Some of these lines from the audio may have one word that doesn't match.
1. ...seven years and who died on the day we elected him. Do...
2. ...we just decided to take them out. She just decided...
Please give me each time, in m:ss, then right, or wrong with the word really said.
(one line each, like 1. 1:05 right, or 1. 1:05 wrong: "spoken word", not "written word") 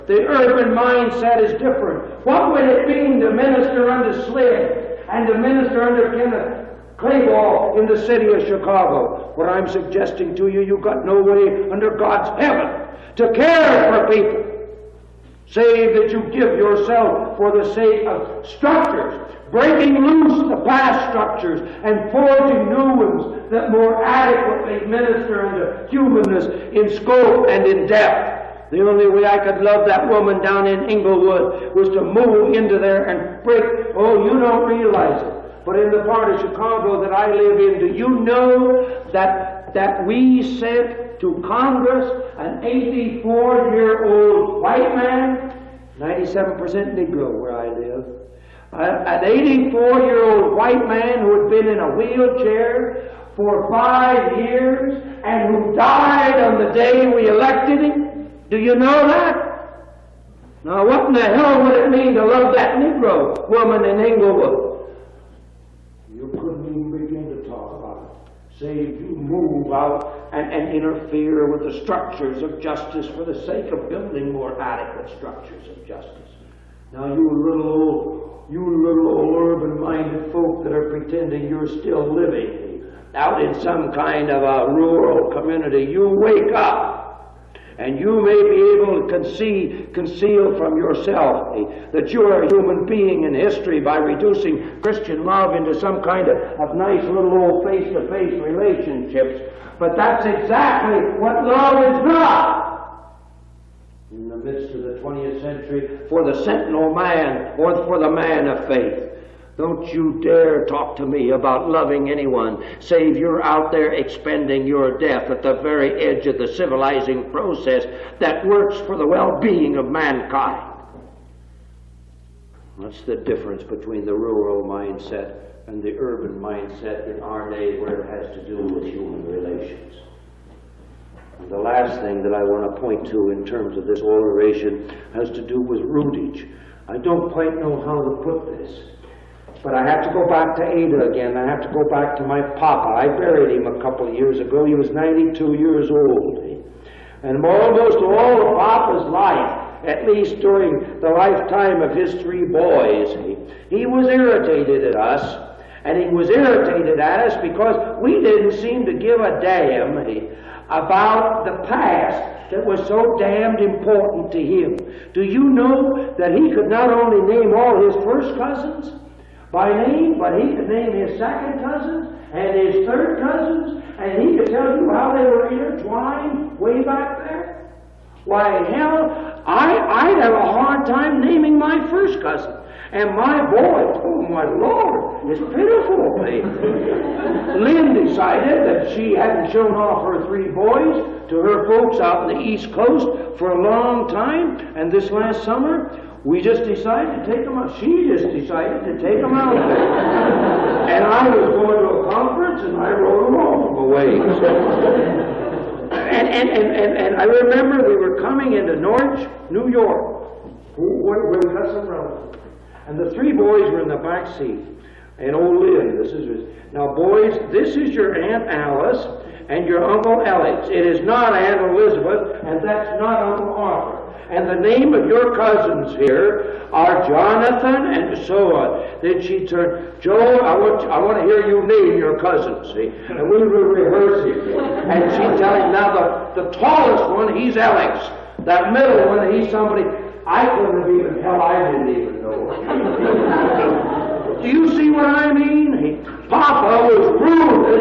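1. 0:53 wrong: "five", not "seven"
2. 3:16 right.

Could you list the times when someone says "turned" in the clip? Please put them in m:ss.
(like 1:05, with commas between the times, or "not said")
3:49.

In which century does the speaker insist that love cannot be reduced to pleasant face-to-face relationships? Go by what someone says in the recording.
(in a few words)
20th century.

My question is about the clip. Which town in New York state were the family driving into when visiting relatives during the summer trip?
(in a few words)
Norwich.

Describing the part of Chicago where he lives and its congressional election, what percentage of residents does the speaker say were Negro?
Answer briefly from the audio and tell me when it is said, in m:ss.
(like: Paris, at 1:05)
97%, at 0:45.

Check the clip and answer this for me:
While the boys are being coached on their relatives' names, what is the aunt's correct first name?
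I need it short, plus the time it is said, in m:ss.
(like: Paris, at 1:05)
Alice, at 3:38.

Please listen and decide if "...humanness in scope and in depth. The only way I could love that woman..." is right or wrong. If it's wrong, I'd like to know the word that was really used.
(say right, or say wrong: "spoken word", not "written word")
right.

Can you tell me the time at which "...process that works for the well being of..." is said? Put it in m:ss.
1:57.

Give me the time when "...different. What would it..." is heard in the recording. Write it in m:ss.
0:01.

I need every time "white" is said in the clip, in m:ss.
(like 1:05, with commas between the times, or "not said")
0:44, 0:50.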